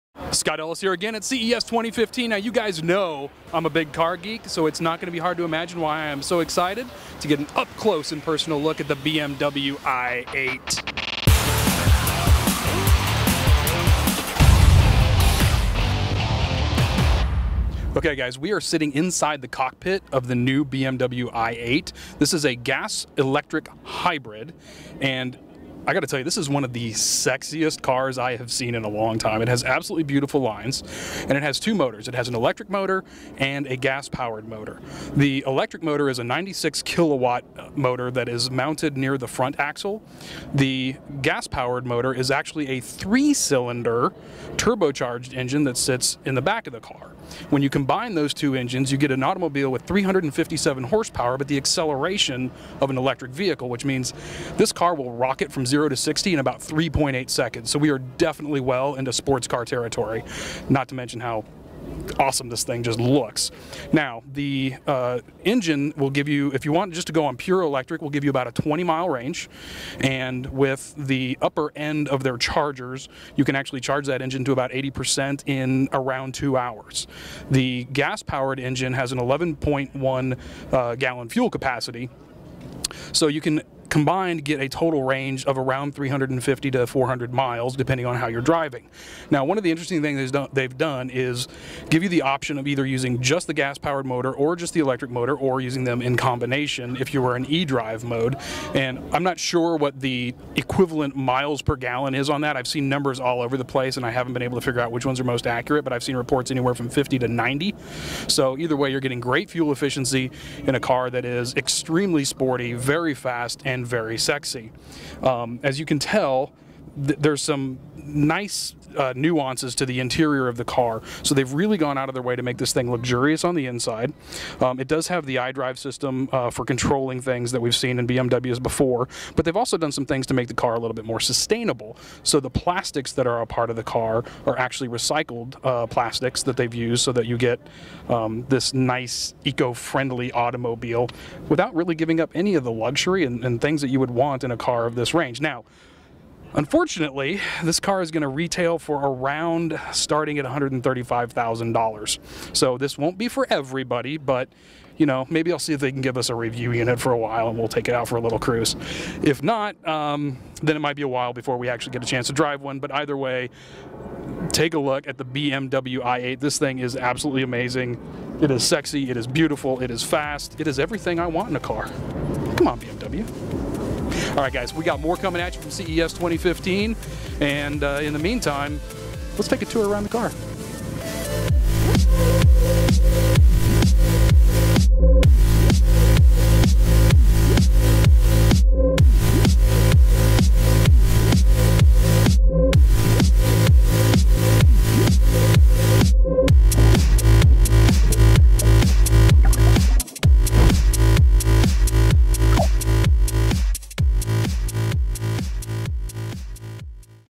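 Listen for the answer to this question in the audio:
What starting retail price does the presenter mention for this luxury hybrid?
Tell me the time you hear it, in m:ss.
2:30.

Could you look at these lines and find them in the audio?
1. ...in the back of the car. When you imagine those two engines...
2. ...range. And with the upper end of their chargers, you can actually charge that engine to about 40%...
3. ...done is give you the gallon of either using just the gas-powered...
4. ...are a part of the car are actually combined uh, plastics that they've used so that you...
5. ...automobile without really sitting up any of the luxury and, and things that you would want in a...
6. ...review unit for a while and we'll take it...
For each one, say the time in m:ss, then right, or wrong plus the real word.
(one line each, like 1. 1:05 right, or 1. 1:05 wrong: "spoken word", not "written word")
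1. 0:46 wrong: "combine", not "imagine"
2. 1:09 wrong: "80", not "40"
3. 1:30 wrong: "option", not "gallon"
4. 2:13 wrong: "recycled", not "combined"
5. 2:20 wrong: "giving", not "sitting"
6. 2:36 right.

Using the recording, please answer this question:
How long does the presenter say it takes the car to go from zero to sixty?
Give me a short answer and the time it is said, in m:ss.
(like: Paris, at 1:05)
3.8 seconds, at 0:56.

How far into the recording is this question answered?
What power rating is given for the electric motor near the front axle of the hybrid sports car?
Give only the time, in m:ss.
0:36.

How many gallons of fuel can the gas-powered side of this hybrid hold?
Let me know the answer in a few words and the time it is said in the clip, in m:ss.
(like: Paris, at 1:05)
11.1 gallons, at 1:19.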